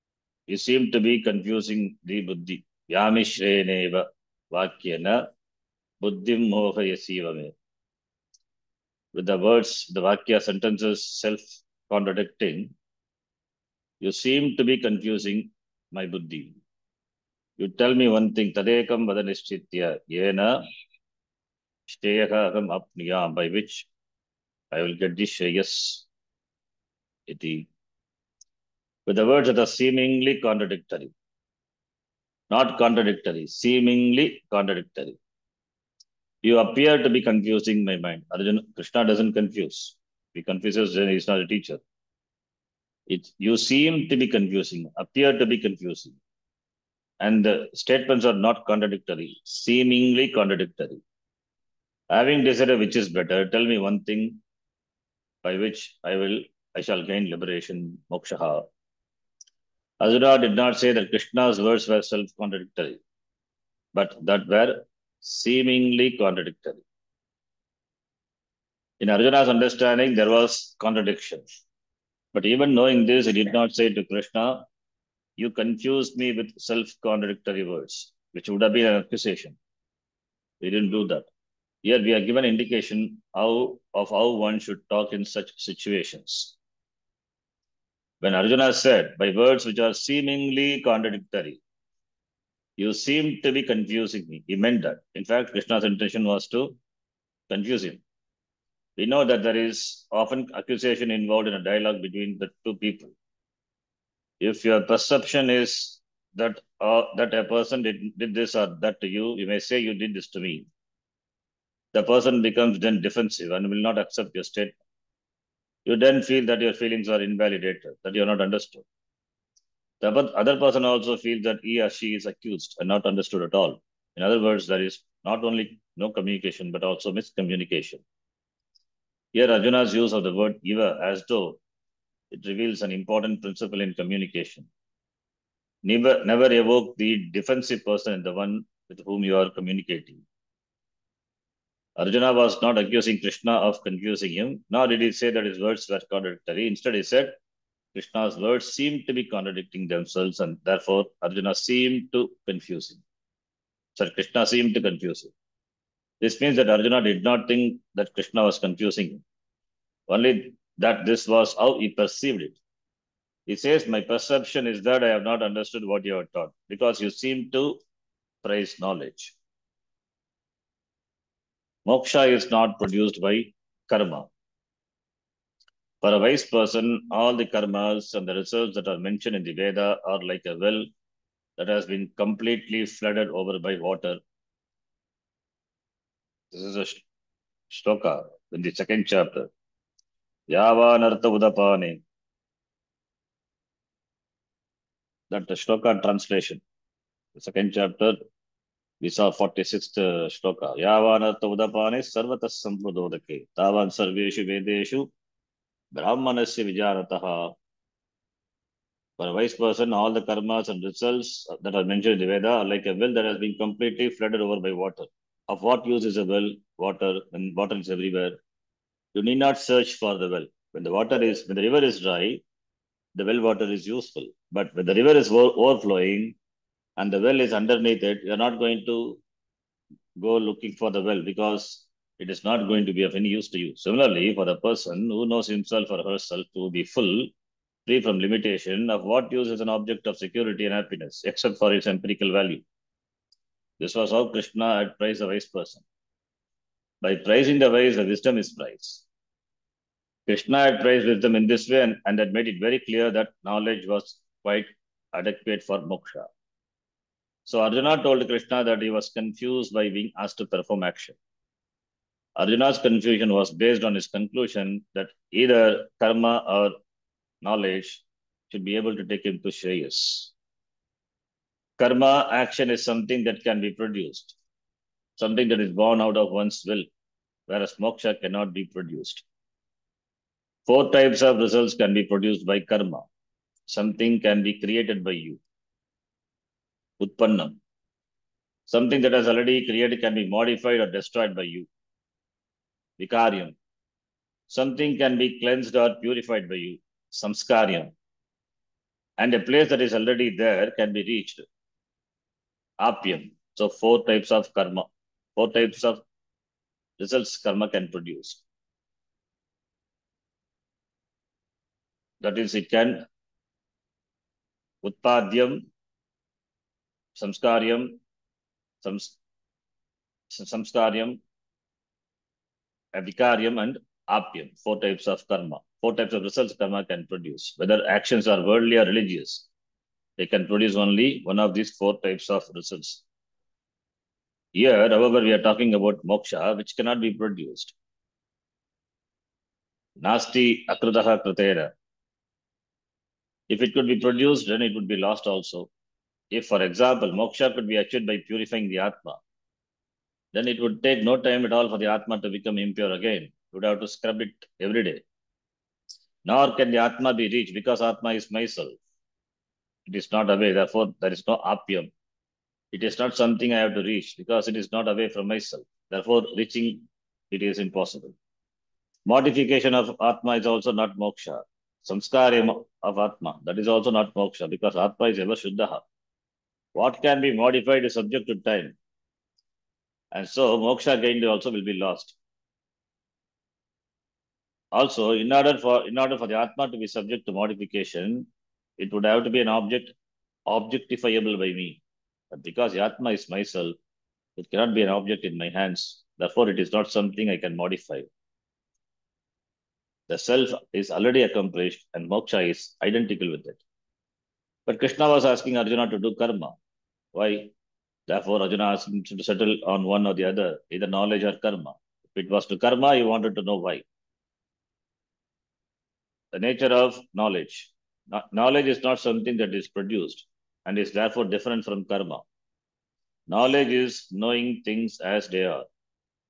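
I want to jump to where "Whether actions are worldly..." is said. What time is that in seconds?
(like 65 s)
327 s.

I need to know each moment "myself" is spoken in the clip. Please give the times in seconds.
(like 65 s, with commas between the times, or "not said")
358 s, 365 s, 393 s.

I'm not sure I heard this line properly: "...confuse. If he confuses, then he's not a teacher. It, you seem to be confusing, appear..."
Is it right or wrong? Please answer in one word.
right.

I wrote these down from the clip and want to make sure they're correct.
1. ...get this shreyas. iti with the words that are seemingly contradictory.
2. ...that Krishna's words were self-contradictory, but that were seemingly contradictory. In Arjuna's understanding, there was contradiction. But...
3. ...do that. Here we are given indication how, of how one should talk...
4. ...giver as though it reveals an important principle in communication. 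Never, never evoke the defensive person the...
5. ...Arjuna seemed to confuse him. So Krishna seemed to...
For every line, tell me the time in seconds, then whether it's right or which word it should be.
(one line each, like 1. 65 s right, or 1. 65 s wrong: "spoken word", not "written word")
1. 24 s right
2. 60 s right
3. 80 s right
4. 130 s right
5. 151 s right.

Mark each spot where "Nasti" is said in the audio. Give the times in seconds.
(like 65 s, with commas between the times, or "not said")
340 s.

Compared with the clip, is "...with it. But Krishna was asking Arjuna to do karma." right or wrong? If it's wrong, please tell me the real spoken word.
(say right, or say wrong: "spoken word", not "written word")
right.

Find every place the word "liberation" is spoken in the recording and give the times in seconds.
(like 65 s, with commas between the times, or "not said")
57 s.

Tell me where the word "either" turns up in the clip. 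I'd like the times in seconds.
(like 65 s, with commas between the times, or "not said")
265 s, 410 s.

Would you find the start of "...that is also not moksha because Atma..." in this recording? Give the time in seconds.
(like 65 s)
373 s.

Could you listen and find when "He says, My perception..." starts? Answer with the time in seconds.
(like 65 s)
163 s.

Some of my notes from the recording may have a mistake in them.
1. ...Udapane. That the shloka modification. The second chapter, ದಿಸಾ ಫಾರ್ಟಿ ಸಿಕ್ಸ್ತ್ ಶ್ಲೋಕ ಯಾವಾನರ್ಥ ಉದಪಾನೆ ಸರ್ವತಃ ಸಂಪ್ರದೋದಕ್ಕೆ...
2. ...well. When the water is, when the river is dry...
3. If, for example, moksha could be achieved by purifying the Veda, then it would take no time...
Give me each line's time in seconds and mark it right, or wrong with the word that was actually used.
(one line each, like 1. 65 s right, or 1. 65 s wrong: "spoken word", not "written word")
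1. 191 s wrong: "translation", not "modification"
2. 220 s right
3. 346 s wrong: "Atma", not "Veda".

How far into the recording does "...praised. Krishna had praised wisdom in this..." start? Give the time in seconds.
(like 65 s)
248 s.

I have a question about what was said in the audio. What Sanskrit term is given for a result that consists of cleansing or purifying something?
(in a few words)
Samskariam.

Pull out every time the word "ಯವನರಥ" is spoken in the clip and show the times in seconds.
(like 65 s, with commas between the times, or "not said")
200 s.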